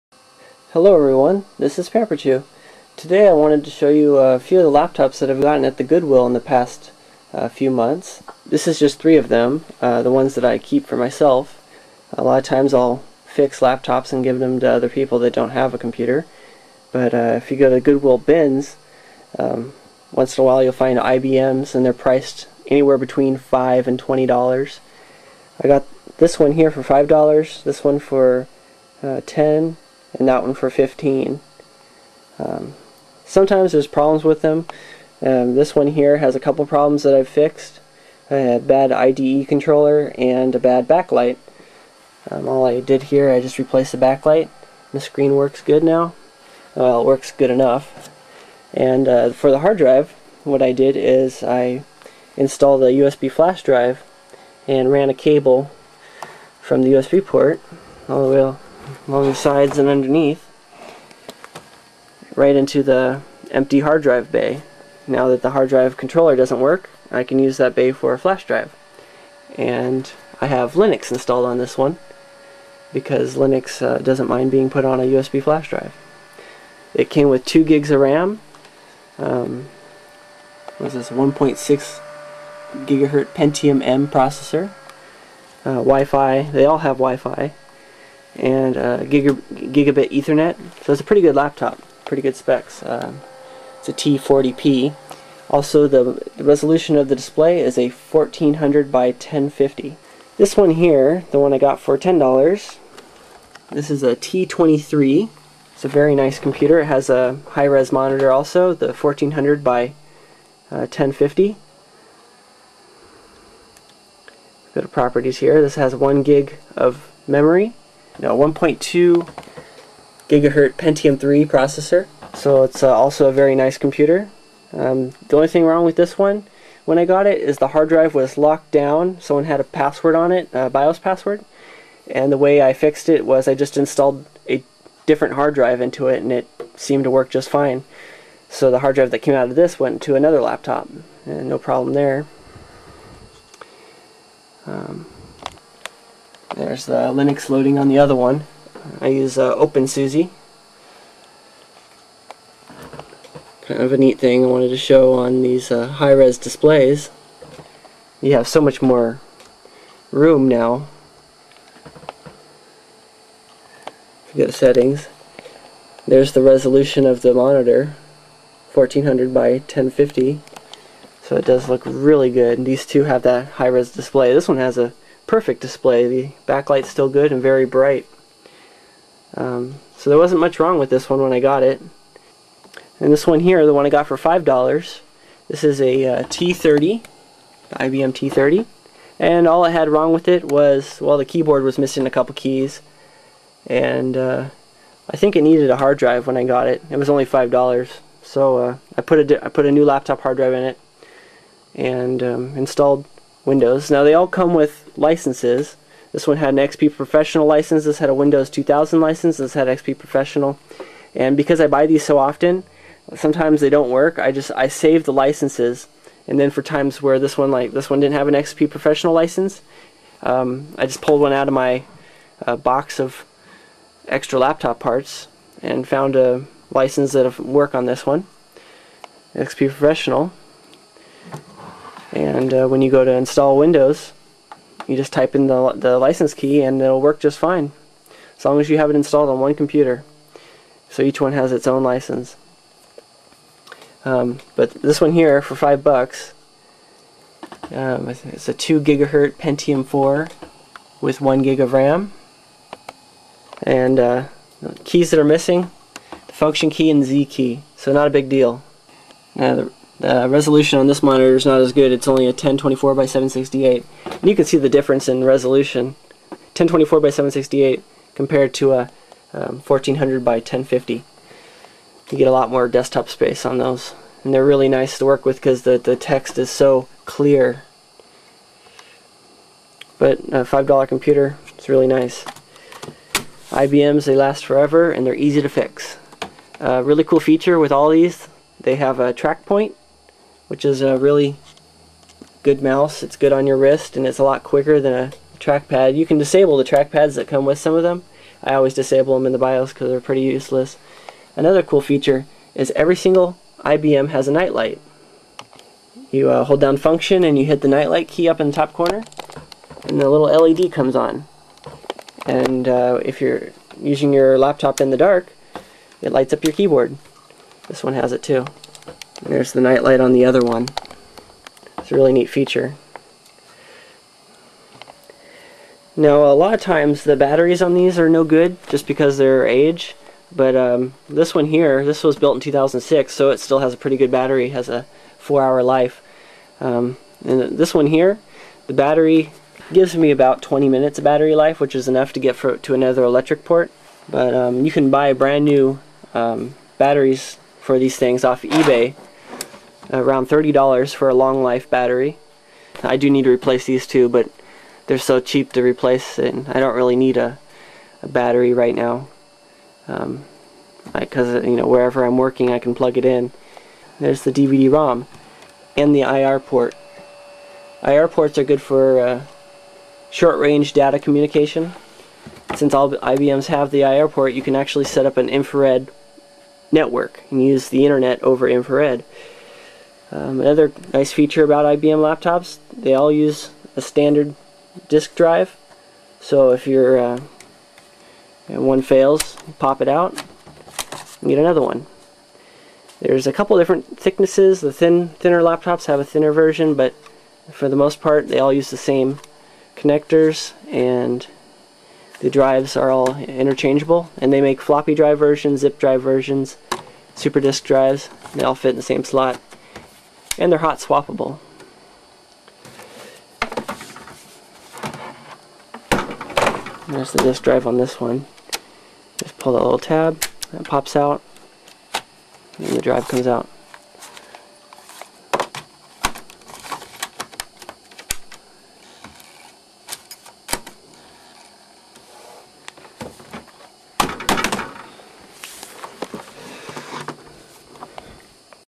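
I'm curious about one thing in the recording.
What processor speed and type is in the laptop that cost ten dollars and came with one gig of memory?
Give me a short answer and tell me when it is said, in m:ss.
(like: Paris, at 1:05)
1.2 gigahertz Pentium 3, at 1:58.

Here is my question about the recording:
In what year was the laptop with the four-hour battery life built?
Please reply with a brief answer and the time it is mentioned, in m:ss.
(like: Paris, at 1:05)
2006, at 5:32.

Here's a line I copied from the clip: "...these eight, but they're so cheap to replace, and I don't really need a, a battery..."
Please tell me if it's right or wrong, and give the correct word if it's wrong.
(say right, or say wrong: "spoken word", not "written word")
wrong: "two", not "eight".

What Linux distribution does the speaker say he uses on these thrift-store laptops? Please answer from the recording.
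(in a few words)
OpenSUSE.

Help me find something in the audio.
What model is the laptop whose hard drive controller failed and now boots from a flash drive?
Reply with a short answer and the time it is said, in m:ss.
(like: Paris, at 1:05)
T40p, at 1:33.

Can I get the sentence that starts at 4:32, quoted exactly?
You get a lot more desktop space on those.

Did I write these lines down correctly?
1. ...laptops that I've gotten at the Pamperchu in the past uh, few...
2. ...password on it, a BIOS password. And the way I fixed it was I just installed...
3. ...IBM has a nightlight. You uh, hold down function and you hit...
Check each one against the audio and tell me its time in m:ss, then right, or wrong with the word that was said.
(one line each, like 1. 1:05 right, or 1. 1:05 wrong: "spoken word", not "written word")
1. 0:04 wrong: "Goodwill", not "Pamperchu"
2. 2:09 right
3. 5:03 right.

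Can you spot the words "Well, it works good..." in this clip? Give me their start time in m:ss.
0:46.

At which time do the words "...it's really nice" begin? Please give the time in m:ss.
4:41.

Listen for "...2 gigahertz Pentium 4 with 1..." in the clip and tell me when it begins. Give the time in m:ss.
4:08.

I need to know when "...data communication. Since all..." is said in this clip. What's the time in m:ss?
6:10.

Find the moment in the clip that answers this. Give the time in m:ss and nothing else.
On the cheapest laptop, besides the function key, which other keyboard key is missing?
4:17.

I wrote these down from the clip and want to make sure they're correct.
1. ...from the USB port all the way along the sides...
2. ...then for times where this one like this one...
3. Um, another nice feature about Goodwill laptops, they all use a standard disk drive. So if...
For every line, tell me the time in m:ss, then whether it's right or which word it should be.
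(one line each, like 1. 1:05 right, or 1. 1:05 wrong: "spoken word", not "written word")
1. 0:56 right
2. 3:36 right
3. 6:20 wrong: "IBM", not "Goodwill".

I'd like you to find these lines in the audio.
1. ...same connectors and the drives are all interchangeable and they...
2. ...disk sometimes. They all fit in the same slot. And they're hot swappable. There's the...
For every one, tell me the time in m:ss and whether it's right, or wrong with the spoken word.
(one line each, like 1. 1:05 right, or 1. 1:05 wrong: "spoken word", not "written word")
1. 6:38 right
2. 6:47 wrong: "drives", not "sometimes".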